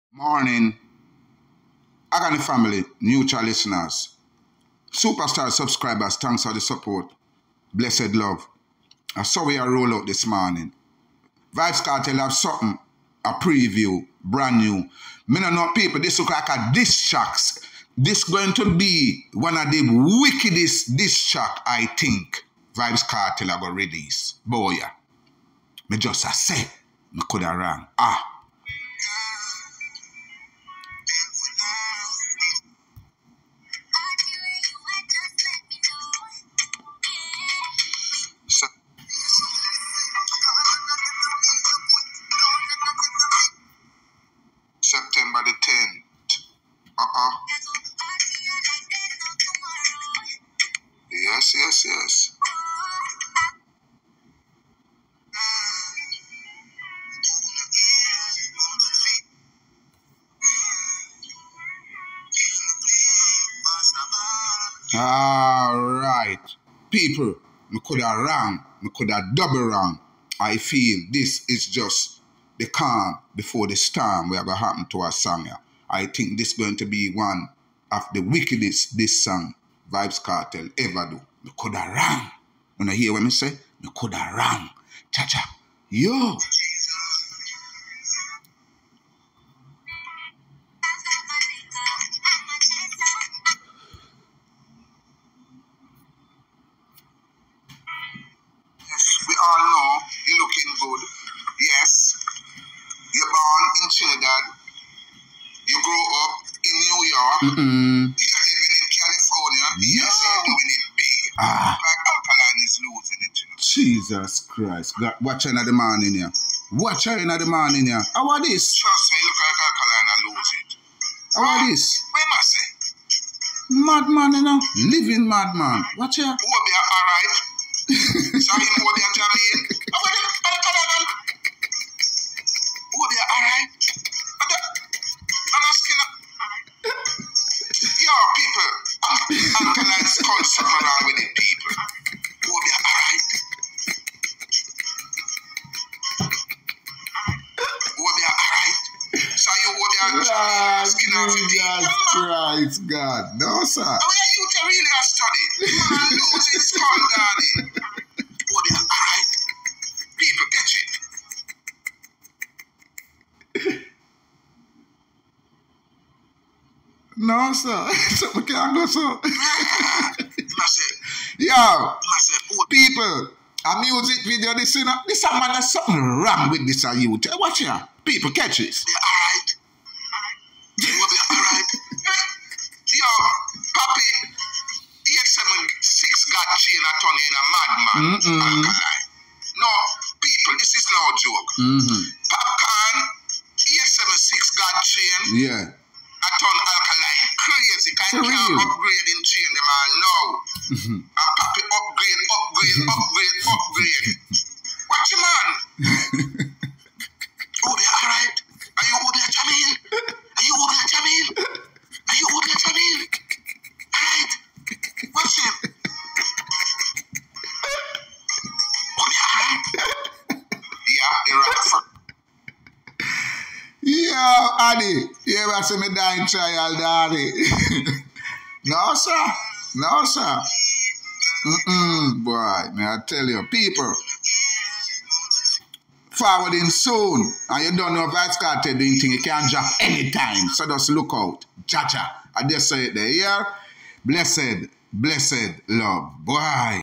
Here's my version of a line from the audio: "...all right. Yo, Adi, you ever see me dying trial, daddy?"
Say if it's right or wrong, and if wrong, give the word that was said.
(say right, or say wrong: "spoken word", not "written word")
right.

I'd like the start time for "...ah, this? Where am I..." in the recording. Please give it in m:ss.
2:01.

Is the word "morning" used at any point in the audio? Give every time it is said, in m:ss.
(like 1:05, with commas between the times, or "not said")
0:00, 0:10.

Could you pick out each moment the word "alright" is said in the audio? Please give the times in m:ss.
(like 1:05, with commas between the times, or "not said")
2:06, 2:22, 2:28, 2:38.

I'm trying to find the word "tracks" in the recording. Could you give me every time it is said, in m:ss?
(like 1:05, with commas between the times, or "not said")
0:17, 0:21.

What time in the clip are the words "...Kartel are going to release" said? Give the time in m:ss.
0:23.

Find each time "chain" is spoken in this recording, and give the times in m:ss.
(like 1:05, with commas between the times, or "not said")
3:06, 3:14.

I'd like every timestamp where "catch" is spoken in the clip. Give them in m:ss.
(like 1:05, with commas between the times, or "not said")
2:40, 2:58.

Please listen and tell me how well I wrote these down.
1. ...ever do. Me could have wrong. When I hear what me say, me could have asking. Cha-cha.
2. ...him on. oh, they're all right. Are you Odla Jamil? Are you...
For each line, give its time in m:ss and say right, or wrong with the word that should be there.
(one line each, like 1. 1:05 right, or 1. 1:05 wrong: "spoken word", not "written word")
1. 1:20 wrong: "wrong", not "asking"
2. 3:25 right.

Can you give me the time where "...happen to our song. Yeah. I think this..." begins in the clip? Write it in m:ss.
1:14.